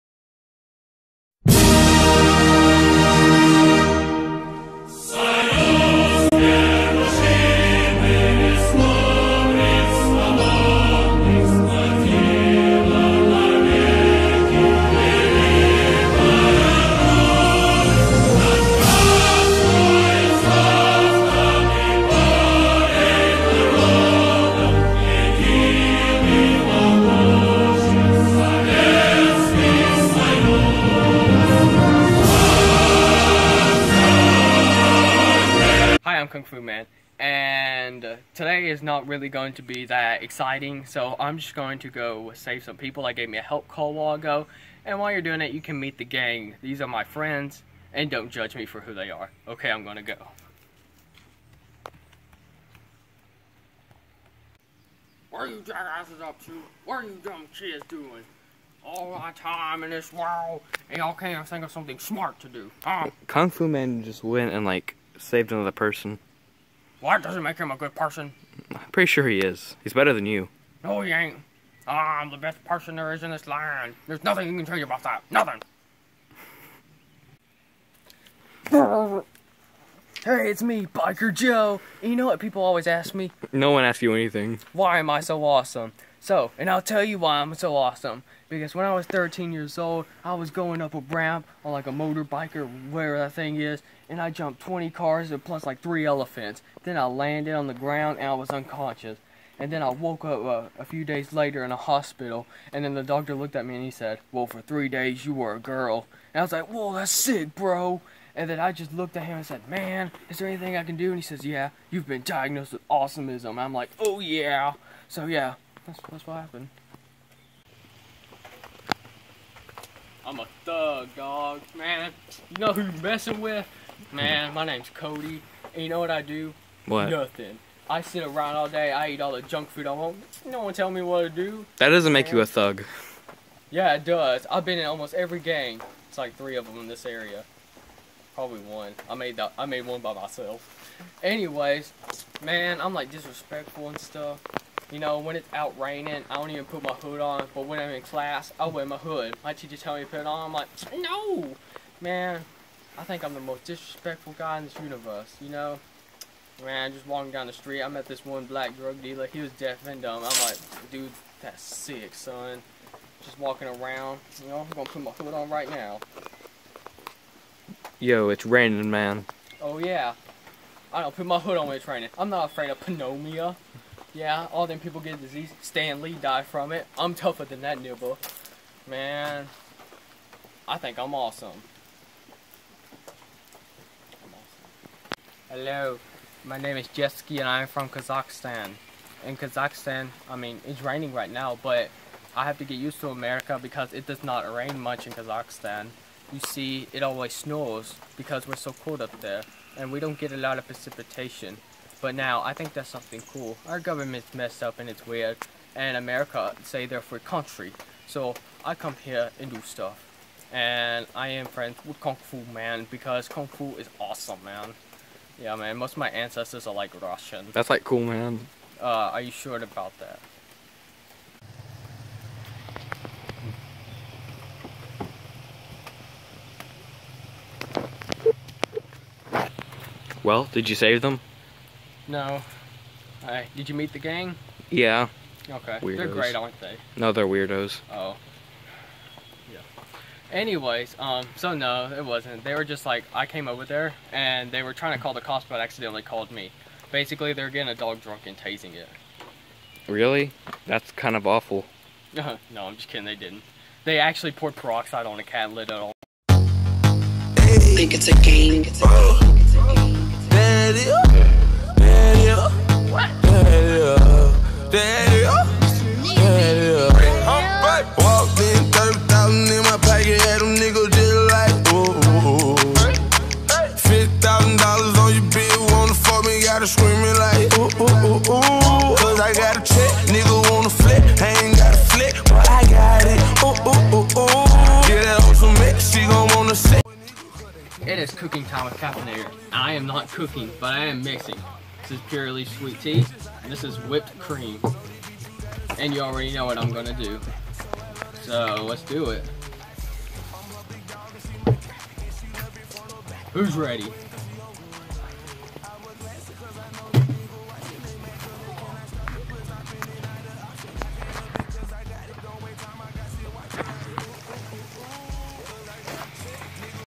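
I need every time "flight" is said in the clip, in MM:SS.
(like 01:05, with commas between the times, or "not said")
not said.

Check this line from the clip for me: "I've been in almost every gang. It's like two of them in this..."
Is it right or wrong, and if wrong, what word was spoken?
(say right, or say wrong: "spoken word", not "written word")
wrong: "three", not "two".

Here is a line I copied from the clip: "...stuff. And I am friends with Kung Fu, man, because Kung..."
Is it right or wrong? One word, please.
right.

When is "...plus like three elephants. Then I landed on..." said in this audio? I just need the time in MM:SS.
01:35.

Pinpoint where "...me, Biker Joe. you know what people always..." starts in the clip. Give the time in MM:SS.
01:20.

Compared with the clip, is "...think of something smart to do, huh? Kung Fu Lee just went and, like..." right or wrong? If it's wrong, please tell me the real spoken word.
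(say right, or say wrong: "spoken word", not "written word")
wrong: "Man", not "Lee".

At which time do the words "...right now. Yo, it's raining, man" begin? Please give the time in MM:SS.
02:45.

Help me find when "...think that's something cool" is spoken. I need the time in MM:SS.
03:22.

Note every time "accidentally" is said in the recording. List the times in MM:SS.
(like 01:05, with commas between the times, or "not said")
04:05.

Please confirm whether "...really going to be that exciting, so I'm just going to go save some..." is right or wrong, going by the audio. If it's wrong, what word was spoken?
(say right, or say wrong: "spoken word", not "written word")
right.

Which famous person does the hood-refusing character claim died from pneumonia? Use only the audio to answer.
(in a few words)
Stan Lee.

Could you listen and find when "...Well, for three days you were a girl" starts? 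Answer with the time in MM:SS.
01:44.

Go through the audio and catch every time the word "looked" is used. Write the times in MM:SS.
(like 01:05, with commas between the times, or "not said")
01:43, 01:48.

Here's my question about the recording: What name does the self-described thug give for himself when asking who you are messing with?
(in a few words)
Cody.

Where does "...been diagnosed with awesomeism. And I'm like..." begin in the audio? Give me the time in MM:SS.
01:52.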